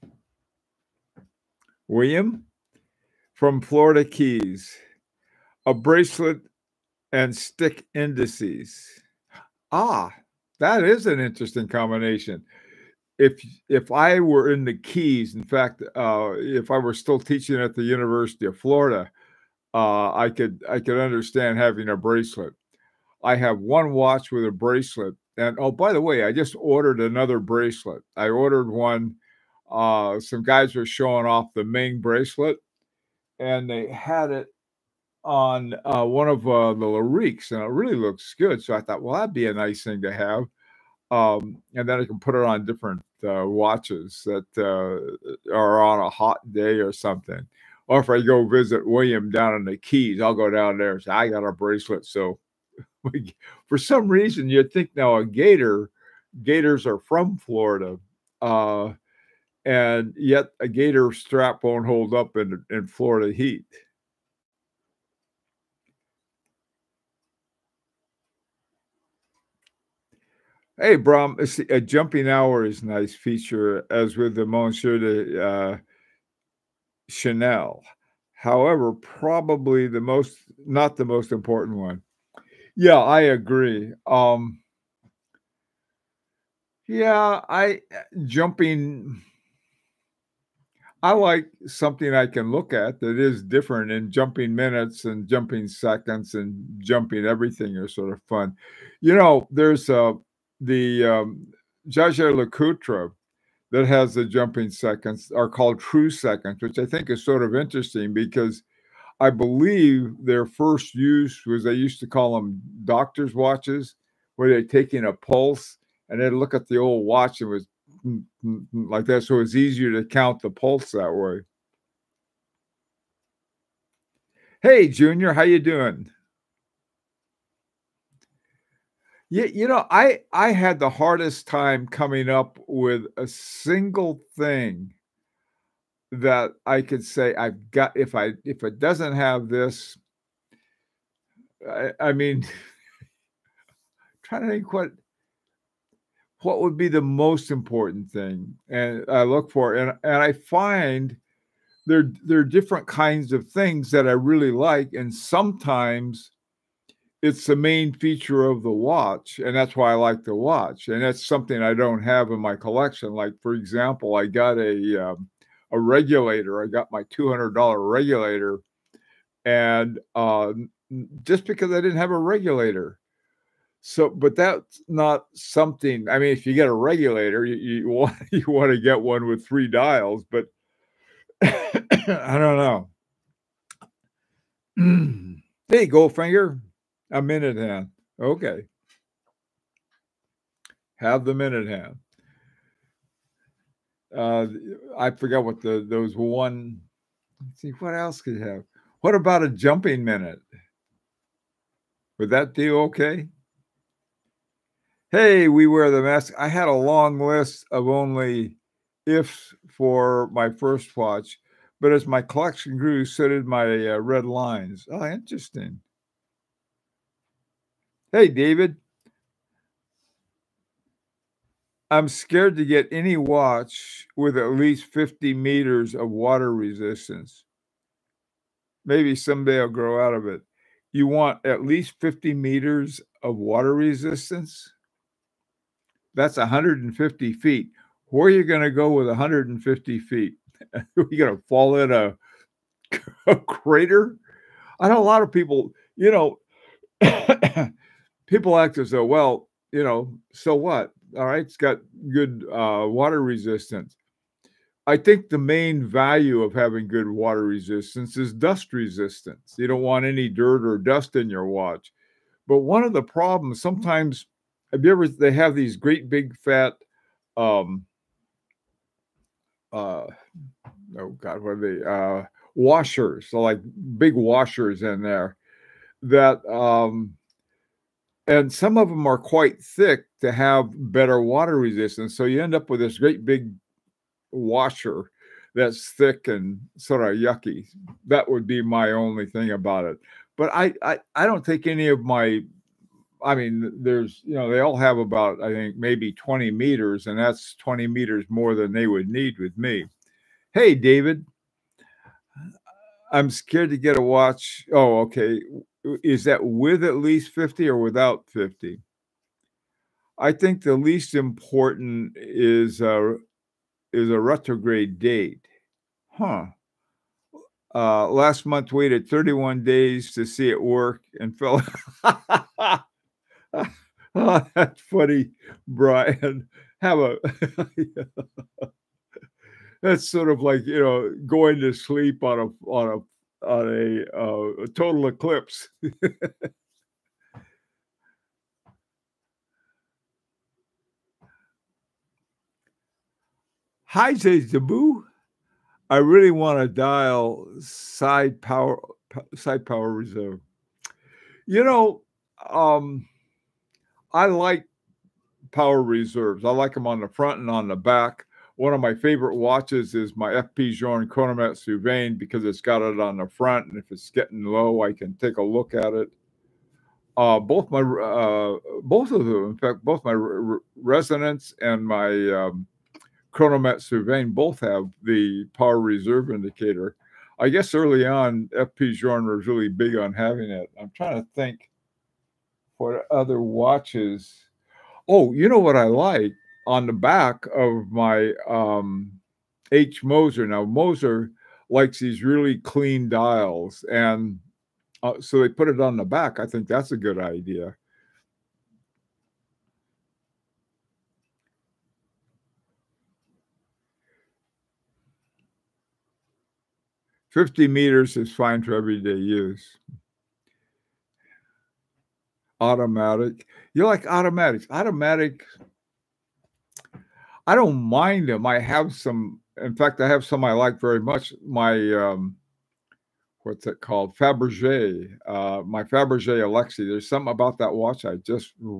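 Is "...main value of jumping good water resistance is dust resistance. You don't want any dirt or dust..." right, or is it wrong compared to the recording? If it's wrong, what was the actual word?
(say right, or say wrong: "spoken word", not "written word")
wrong: "having", not "jumping".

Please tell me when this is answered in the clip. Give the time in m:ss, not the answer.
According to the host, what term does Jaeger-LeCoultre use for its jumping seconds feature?
1:45.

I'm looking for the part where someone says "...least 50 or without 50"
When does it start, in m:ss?
5:06.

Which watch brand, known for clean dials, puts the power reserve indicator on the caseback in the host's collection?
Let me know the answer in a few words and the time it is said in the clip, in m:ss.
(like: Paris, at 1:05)
H Moser, at 6:29.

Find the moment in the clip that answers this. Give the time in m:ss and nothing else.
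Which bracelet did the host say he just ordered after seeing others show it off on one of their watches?
0:31.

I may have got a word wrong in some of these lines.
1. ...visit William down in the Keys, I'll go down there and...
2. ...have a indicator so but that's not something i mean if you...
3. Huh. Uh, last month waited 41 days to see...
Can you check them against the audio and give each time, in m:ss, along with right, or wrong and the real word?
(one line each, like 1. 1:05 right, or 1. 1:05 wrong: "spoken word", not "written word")
1. 0:48 right
2. 2:51 wrong: "regulator", not "indicator"
3. 5:16 wrong: "31", not "41".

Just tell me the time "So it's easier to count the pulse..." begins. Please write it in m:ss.
1:59.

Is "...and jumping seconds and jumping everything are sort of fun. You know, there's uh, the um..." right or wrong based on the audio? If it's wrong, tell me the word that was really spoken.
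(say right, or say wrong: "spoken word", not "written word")
right.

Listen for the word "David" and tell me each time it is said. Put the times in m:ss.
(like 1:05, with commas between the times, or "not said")
3:38, 5:00.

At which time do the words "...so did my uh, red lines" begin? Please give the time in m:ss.
3:33.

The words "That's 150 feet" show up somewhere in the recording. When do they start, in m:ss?
3:56.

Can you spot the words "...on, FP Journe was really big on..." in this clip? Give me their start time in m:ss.
6:18.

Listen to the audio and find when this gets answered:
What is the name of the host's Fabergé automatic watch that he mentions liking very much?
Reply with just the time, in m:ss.
7:06.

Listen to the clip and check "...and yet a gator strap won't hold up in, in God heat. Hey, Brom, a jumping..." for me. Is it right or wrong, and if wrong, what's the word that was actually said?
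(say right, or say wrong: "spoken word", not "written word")
wrong: "Florida", not "God".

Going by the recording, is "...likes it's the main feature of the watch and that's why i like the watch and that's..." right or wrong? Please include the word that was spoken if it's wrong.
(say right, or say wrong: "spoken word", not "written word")
wrong: "sometimes", not "likes".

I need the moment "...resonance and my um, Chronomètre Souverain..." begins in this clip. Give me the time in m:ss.
6:10.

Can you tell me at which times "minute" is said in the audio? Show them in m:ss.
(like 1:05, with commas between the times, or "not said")
1:34, 3:07, 3:11, 3:20.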